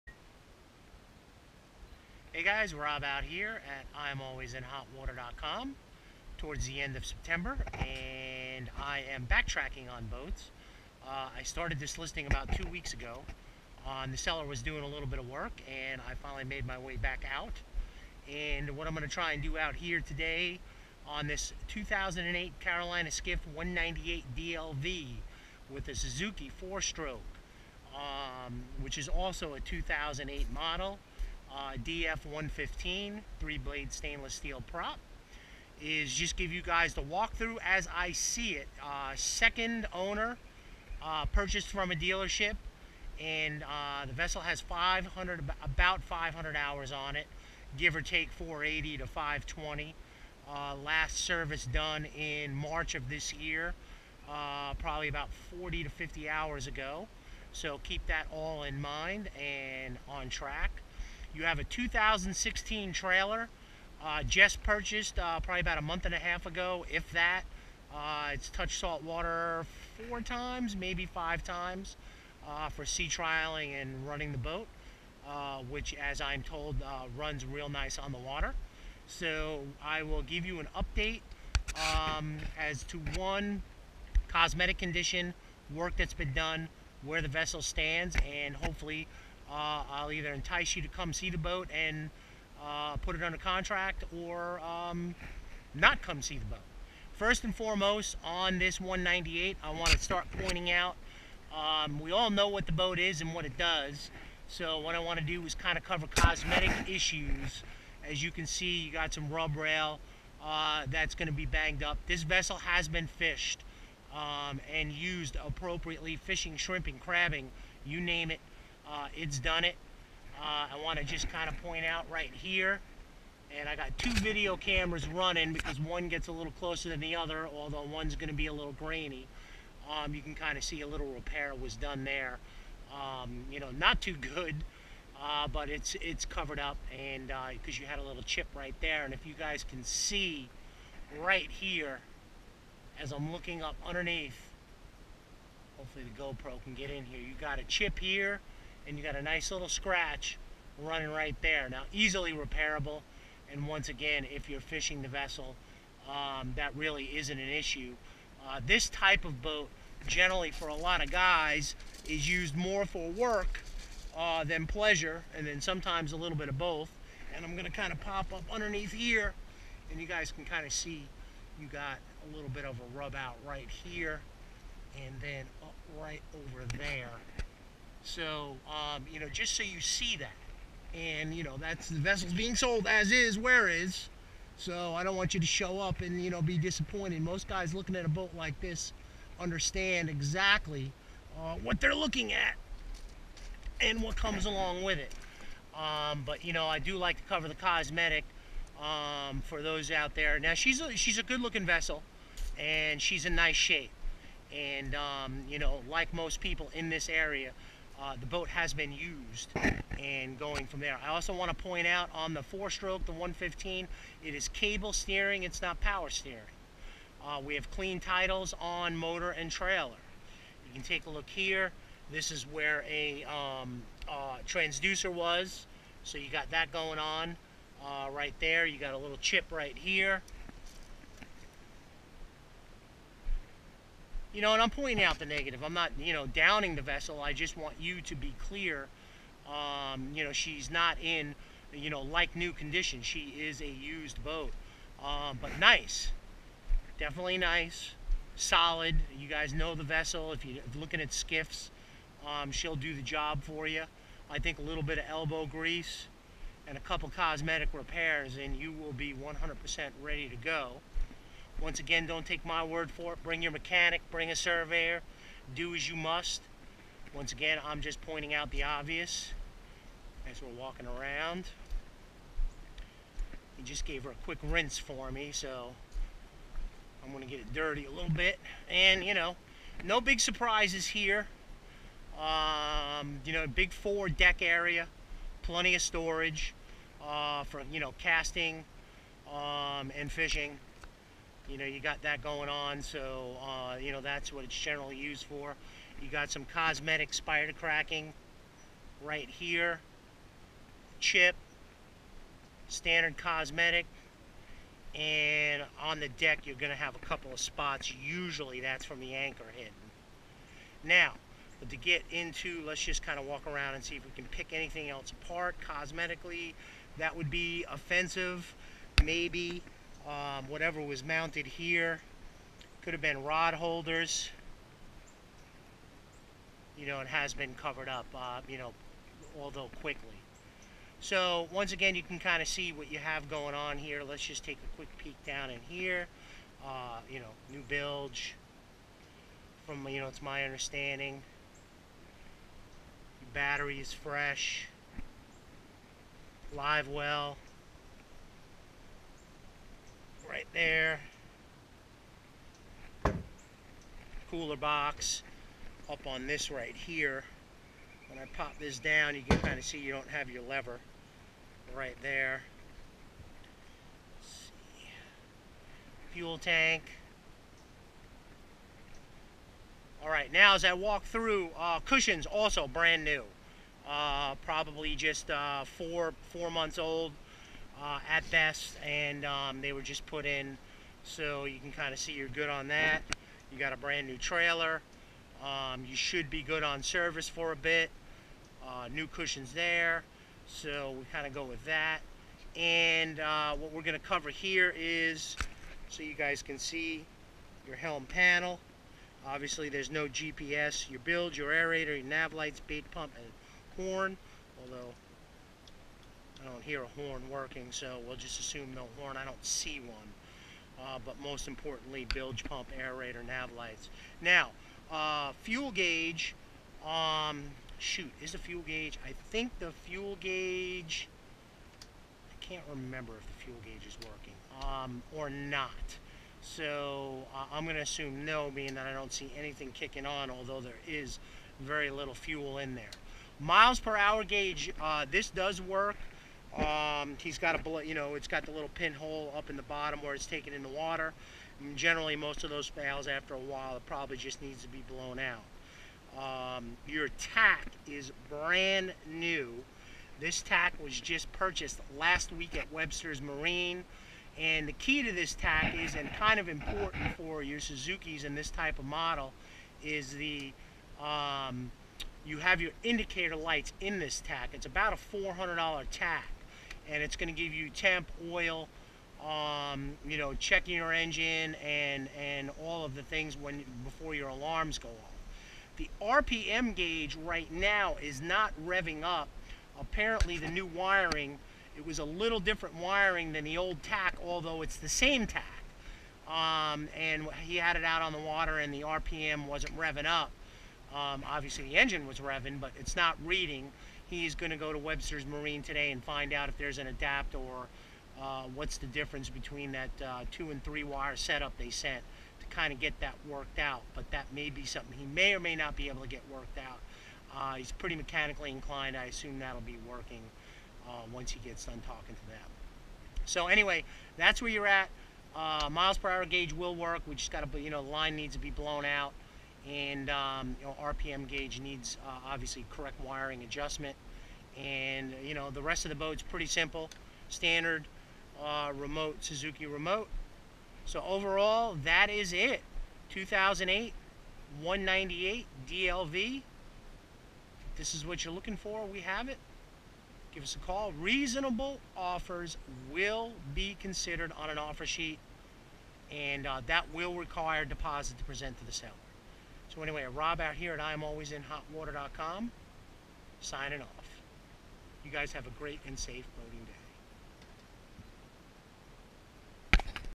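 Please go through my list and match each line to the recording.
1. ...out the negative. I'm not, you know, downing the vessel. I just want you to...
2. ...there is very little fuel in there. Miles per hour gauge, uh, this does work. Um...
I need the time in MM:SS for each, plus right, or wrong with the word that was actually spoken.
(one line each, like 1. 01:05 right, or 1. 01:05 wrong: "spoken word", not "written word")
1. 03:55 right
2. 07:10 right.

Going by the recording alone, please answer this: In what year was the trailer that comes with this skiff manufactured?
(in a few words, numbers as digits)
2016.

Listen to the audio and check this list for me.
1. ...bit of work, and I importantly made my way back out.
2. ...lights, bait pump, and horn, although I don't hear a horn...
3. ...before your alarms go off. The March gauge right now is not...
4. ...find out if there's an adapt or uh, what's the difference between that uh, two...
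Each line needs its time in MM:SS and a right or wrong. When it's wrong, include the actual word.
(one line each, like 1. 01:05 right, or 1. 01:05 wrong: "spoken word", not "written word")
1. 00:15 wrong: "finally", not "importantly"
2. 06:42 right
3. 07:53 wrong: "RPM", not "March"
4. 08:16 right.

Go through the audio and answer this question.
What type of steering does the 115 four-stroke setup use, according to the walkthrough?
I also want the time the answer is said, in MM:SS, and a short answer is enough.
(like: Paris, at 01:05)
cable steering, at 03:34.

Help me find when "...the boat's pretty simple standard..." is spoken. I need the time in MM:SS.
08:45.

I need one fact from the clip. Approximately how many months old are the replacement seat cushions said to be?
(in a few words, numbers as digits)
4 months.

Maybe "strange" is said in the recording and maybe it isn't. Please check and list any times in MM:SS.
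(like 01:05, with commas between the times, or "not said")
not said.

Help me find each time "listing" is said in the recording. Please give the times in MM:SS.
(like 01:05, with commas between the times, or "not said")
00:11.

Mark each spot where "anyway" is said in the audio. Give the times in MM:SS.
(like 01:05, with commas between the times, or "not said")
08:33, 09:09.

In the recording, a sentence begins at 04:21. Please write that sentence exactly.
Once again, don't take my word for it.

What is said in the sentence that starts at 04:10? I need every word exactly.
If you're looking at skiffs, um, she'll do the job for you.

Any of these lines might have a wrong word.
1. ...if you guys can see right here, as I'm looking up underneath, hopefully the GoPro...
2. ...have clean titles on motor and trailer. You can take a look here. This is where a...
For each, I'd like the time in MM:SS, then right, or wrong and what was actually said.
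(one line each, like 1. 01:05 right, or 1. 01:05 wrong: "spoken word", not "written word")
1. 02:19 right
2. 03:37 right.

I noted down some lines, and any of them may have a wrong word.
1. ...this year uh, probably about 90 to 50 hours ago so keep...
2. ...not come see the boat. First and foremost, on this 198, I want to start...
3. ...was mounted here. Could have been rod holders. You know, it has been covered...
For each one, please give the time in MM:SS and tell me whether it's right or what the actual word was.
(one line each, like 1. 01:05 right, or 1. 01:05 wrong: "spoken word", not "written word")
1. 00:53 wrong: "40", not "90"
2. 01:35 right
3. 05:20 right.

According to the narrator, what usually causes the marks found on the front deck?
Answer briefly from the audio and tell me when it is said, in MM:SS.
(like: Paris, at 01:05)
the anchor hitting, at 05:09.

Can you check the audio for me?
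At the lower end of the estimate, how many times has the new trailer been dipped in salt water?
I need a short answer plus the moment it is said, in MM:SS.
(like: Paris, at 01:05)
4, at 01:10.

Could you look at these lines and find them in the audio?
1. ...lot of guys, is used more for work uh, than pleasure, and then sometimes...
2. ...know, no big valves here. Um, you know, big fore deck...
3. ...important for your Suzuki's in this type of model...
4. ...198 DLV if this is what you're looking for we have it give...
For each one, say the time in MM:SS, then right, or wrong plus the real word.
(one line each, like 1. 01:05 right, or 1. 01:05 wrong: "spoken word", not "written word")
1. 02:40 right
2. 04:39 wrong: "surprises", not "valves"
3. 07:36 right
4. 08:54 right.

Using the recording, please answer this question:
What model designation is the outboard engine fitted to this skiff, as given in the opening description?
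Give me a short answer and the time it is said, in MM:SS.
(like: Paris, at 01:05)
DF115, at 00:31.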